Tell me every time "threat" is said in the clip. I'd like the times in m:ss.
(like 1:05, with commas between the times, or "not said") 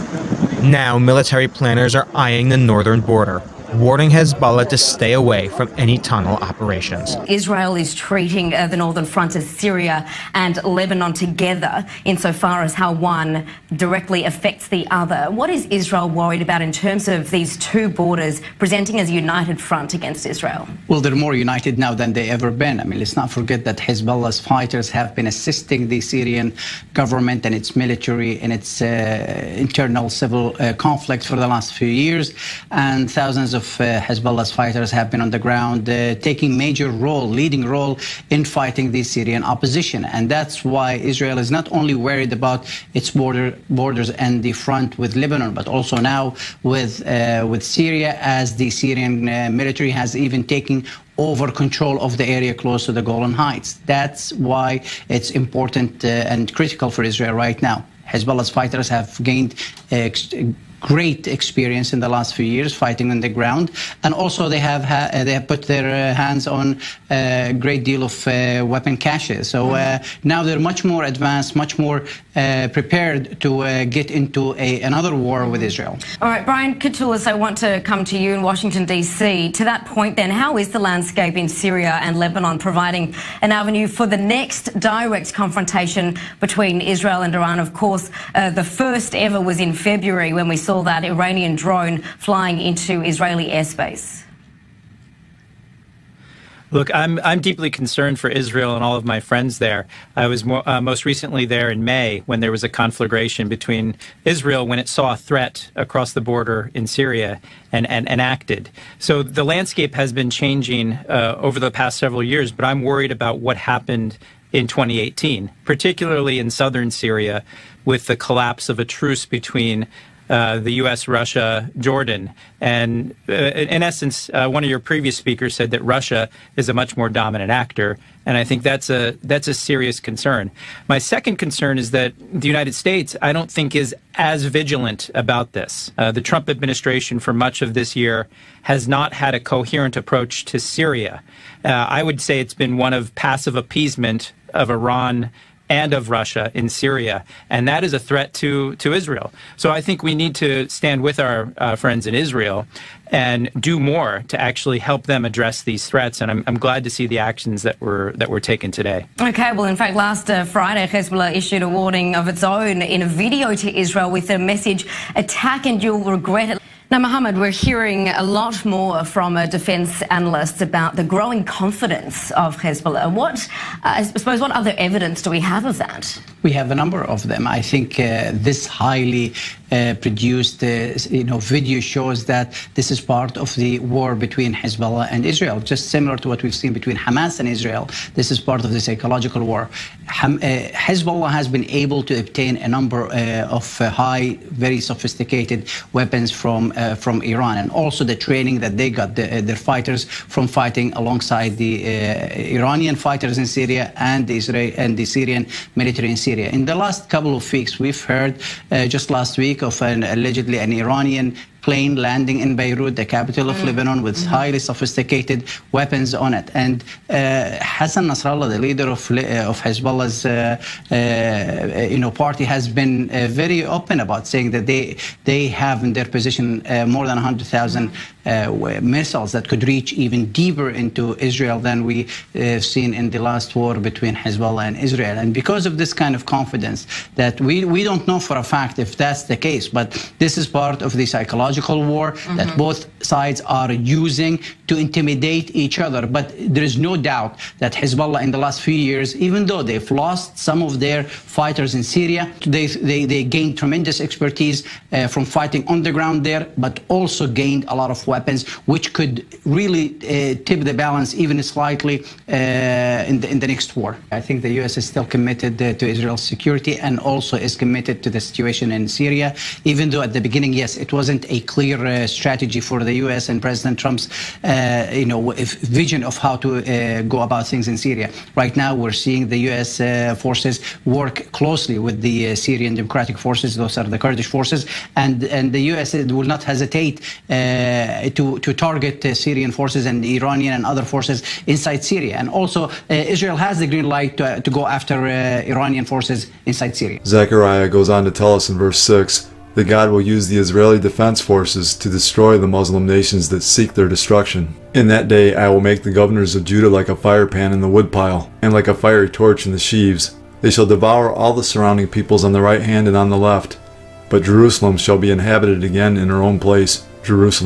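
1:45, 2:27, 2:35.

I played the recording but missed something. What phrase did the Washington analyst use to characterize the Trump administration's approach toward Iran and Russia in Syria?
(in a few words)
passive appeasement.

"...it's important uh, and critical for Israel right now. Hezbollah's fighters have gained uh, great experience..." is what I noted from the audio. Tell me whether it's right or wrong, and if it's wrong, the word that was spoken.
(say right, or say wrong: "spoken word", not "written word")
right.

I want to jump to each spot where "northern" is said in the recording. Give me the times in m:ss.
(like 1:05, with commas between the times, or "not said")
0:02, 0:08.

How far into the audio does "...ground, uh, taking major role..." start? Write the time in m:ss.
0:35.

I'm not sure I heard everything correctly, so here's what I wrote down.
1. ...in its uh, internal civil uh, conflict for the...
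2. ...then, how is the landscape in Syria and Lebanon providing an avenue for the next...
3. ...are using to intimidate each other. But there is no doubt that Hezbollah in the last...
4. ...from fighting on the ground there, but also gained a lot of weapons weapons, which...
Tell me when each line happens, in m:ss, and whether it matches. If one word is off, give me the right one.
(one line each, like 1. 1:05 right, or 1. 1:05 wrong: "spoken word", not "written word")
1. 0:28 right
2. 1:20 right
3. 4:03 right
4. 4:15 right.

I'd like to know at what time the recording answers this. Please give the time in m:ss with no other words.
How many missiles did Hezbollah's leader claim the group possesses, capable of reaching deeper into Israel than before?
3:46.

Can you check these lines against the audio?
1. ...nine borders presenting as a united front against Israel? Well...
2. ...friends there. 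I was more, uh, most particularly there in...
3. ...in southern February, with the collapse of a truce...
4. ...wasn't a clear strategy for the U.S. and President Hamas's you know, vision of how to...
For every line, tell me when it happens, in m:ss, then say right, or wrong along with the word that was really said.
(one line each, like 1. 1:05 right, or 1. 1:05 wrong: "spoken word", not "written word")
1. 0:17 wrong: "two", not "nine"
2. 1:39 wrong: "recently", not "particularly"
3. 1:56 wrong: "Syria", not "February"
4. 4:30 wrong: "Trump", not "Hamas".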